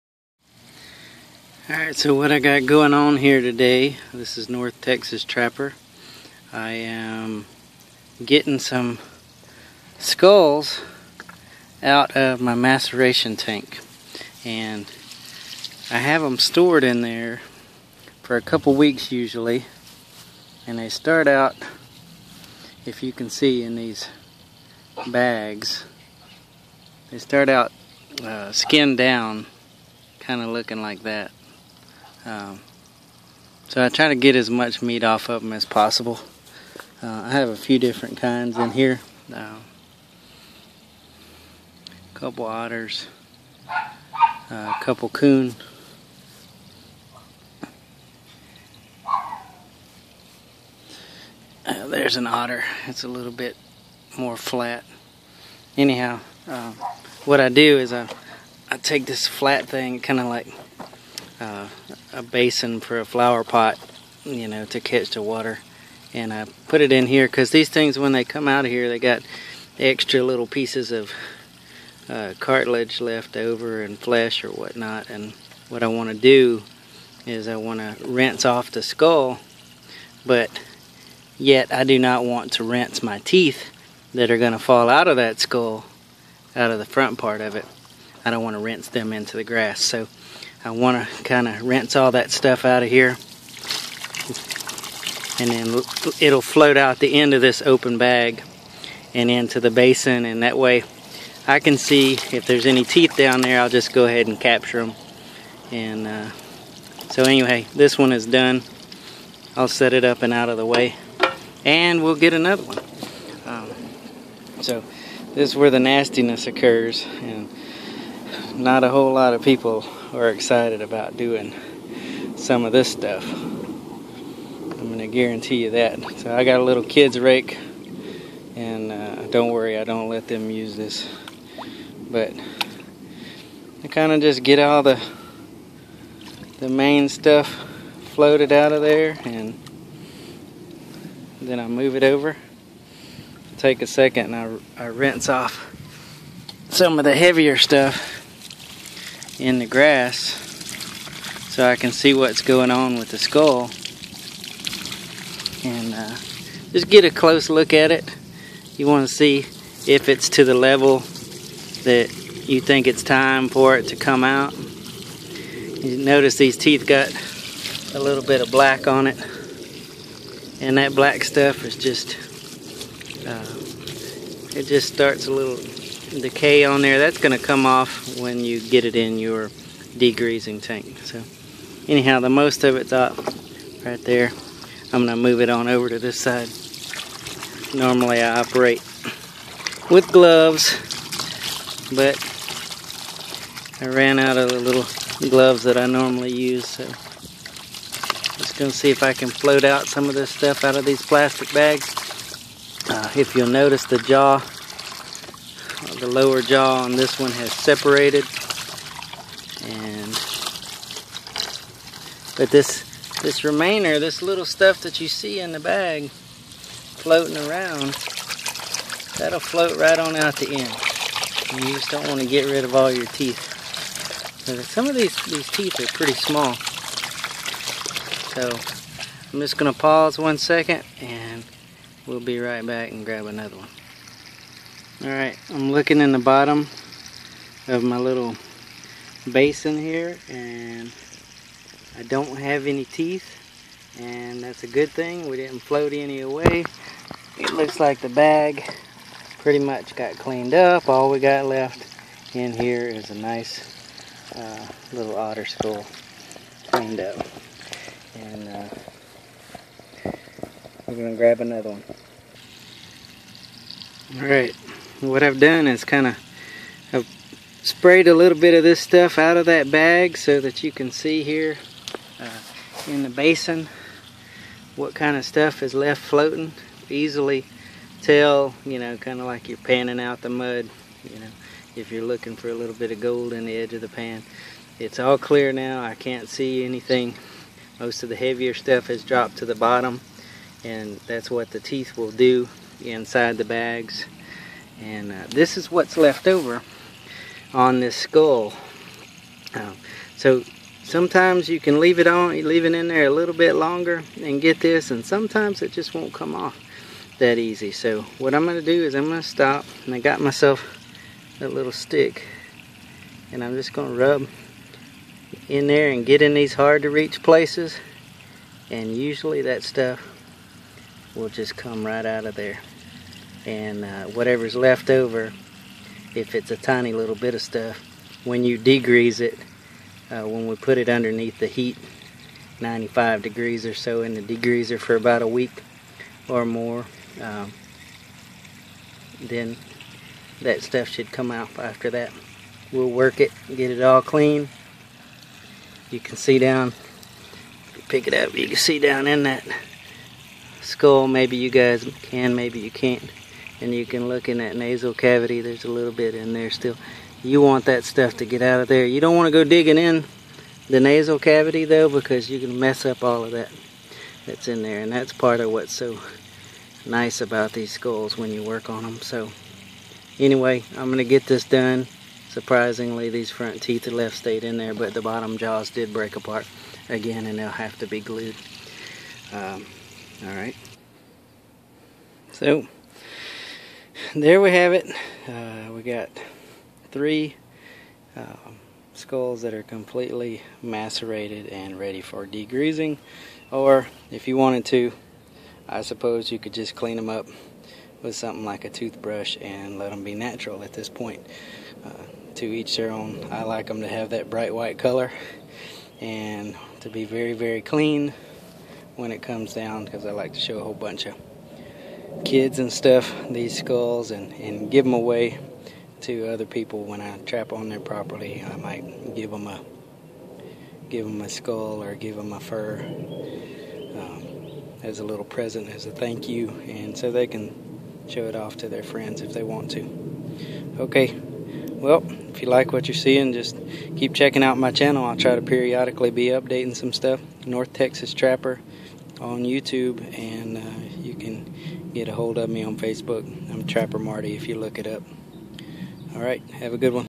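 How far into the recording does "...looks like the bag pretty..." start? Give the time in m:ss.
4:07.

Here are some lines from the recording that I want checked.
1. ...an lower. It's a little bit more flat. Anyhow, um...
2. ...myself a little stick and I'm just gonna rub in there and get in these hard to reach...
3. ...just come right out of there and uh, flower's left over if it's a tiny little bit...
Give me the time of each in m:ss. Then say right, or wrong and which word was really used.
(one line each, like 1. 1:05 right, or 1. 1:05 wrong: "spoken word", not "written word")
1. 0:52 wrong: "otter", not "lower"
2. 5:10 right
3. 5:21 wrong: "whatever", not "flower".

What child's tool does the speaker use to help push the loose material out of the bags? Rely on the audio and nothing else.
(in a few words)
Kid's rake.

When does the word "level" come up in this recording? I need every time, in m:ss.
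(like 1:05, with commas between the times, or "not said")
2:40.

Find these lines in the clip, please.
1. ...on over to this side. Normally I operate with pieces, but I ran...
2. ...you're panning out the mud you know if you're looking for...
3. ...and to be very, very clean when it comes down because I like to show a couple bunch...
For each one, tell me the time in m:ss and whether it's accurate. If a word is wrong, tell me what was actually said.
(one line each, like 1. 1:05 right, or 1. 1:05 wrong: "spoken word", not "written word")
1. 3:05 wrong: "gloves", not "pieces"
2. 4:39 right
3. 6:45 wrong: "whole", not "couple".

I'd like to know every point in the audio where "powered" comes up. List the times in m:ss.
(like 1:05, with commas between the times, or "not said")
not said.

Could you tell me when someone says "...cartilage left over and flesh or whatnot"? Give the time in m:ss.
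1:12.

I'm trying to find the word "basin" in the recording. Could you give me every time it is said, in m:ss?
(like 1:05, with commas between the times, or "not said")
1:02, 1:39, 3:59, 4:33.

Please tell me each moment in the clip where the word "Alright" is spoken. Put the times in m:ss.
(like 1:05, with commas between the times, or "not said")
0:01, 3:55, 4:24.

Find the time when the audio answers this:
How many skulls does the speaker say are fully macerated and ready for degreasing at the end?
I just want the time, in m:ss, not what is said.
6:26.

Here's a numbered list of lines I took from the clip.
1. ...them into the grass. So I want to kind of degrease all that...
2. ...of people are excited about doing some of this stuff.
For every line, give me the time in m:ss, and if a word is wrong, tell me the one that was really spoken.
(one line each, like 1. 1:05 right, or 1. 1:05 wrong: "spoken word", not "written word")
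1. 1:28 wrong: "rinse", not "degrease"
2. 1:59 right.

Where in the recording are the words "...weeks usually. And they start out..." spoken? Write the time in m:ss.
0:18.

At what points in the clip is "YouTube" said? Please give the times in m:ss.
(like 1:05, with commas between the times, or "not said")
7:19.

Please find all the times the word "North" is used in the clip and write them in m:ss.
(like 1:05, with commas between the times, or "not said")
0:04, 7:17.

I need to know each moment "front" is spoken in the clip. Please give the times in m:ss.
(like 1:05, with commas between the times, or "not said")
1:26, 6:13.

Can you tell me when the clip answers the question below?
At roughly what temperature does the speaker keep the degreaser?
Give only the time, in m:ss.
5:32.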